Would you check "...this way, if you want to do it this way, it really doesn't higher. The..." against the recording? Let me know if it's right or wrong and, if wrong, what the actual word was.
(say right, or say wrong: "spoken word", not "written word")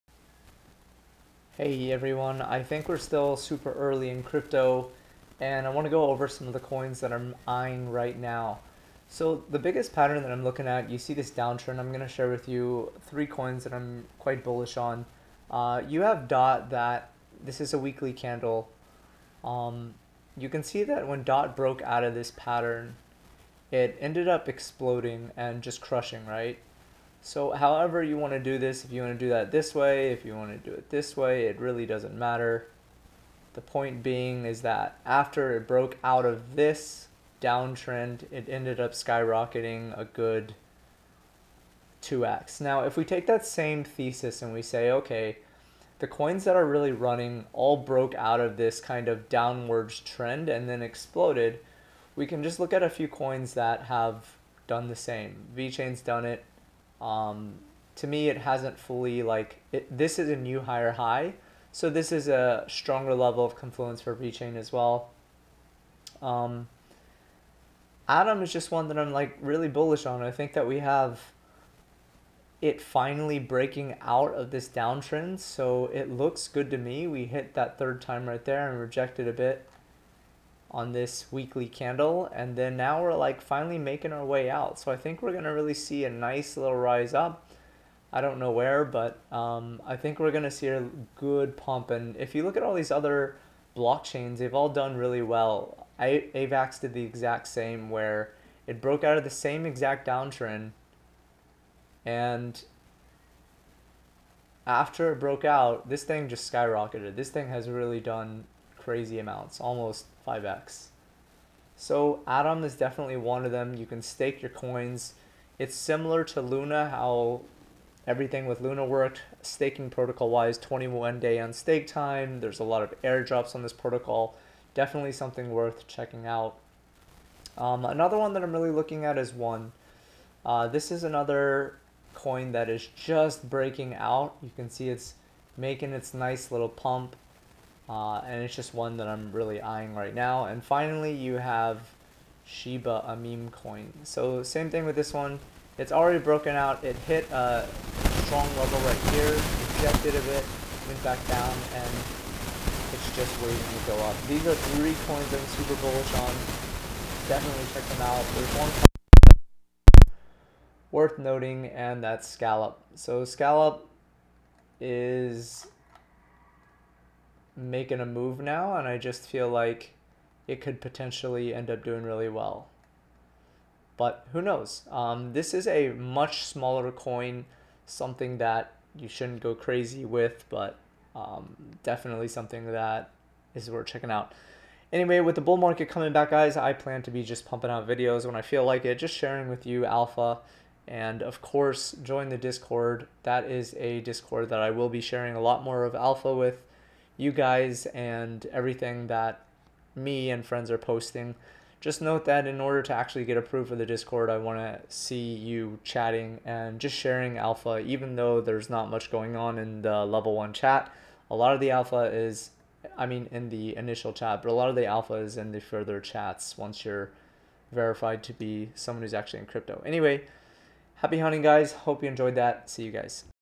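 wrong: "matter", not "higher".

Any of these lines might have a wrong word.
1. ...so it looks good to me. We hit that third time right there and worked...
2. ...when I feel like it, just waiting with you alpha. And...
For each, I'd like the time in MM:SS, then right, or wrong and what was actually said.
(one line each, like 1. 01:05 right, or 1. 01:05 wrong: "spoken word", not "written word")
1. 01:15 wrong: "rejected", not "worked"
2. 03:08 wrong: "sharing", not "waiting".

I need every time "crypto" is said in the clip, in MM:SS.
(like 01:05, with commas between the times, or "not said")
00:04, 03:39.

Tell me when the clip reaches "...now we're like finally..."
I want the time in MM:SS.
01:22.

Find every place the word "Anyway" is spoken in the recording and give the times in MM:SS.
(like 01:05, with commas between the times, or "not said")
03:04, 03:39.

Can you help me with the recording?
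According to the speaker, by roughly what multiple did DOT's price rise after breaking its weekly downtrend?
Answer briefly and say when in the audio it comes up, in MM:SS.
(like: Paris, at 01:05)
2x, at 00:42.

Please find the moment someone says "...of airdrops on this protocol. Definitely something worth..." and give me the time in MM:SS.
02:02.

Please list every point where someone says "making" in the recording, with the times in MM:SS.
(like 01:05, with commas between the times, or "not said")
01:23, 02:15, 02:47.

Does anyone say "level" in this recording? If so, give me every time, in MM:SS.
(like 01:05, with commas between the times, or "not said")
01:03, 02:28, 03:30.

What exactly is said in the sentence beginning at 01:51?
So Atom is definitely one of them.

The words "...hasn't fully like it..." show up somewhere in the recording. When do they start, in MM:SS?
00:58.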